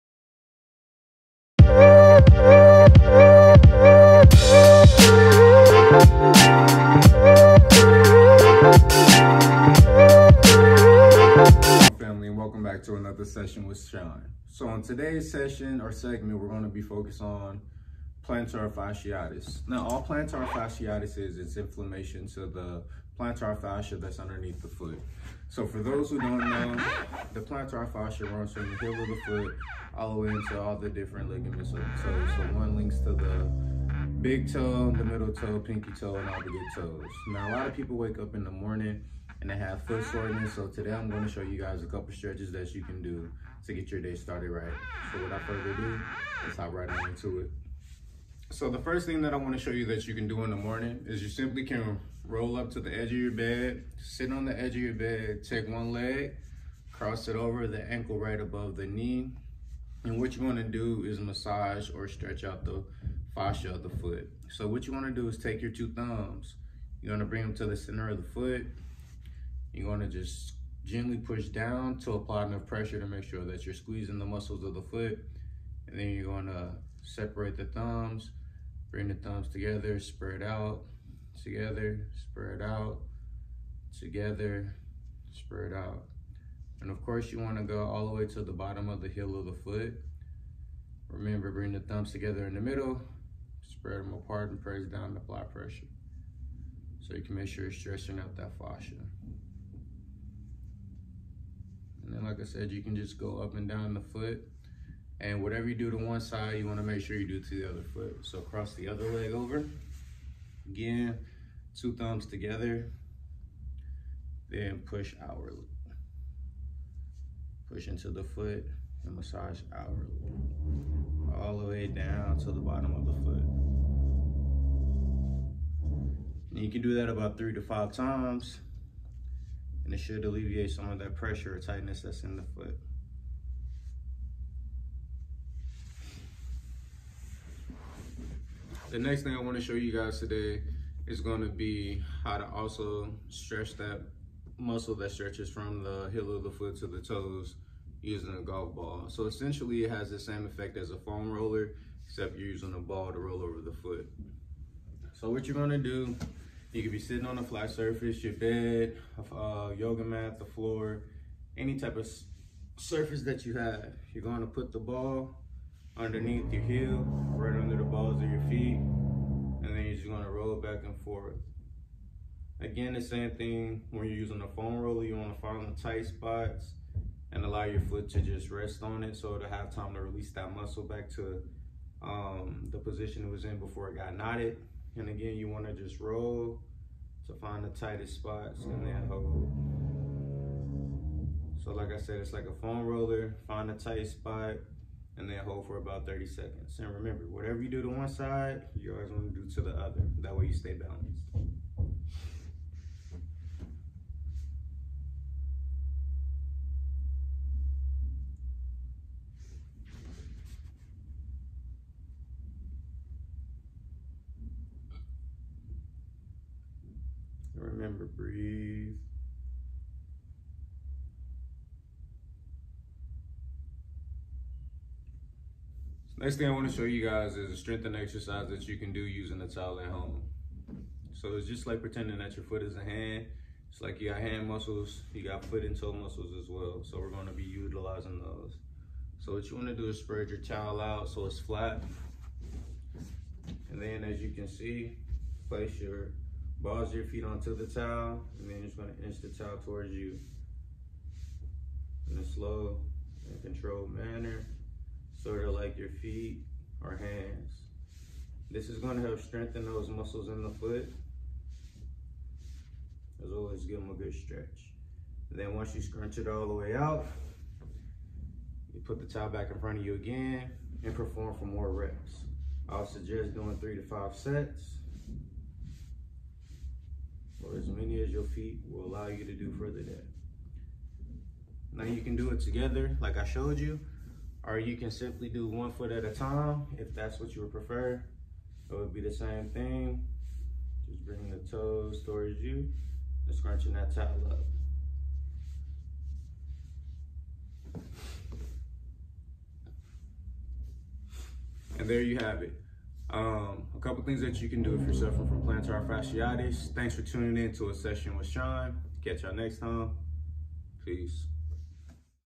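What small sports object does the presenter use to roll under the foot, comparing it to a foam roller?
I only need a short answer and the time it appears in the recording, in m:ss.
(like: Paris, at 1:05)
golf ball, at 2:28.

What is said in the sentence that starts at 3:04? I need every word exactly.
And again, you wanna just roll to find the tightest spots and then mm-hmm.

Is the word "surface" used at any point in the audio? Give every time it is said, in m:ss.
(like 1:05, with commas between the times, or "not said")
2:37, 2:42.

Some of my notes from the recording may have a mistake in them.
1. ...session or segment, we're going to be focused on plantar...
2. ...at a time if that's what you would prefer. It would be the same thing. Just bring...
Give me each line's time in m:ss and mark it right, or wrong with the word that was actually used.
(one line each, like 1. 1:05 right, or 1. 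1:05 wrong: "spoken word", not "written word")
1. 0:15 right
2. 4:45 right.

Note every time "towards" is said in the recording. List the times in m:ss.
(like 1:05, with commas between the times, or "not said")
4:09, 4:52.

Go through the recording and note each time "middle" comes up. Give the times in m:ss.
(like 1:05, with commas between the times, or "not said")
0:35, 1:32.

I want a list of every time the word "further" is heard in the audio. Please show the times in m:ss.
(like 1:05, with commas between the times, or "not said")
0:45, 4:39.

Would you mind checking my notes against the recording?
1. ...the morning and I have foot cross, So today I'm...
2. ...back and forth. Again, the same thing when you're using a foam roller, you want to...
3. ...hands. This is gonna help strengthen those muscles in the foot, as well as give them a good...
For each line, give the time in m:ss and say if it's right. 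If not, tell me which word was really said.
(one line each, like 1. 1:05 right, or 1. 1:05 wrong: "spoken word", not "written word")
1. 0:38 wrong: "soreness", not "cross"
2. 2:50 right
3. 4:16 right.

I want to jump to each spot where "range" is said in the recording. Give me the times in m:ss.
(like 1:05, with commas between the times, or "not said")
not said.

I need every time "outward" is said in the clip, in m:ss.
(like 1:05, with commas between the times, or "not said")
1:55, 1:59.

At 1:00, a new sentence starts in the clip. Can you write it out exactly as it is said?
And what you want to do is massage or stretch out the fascia of the foot.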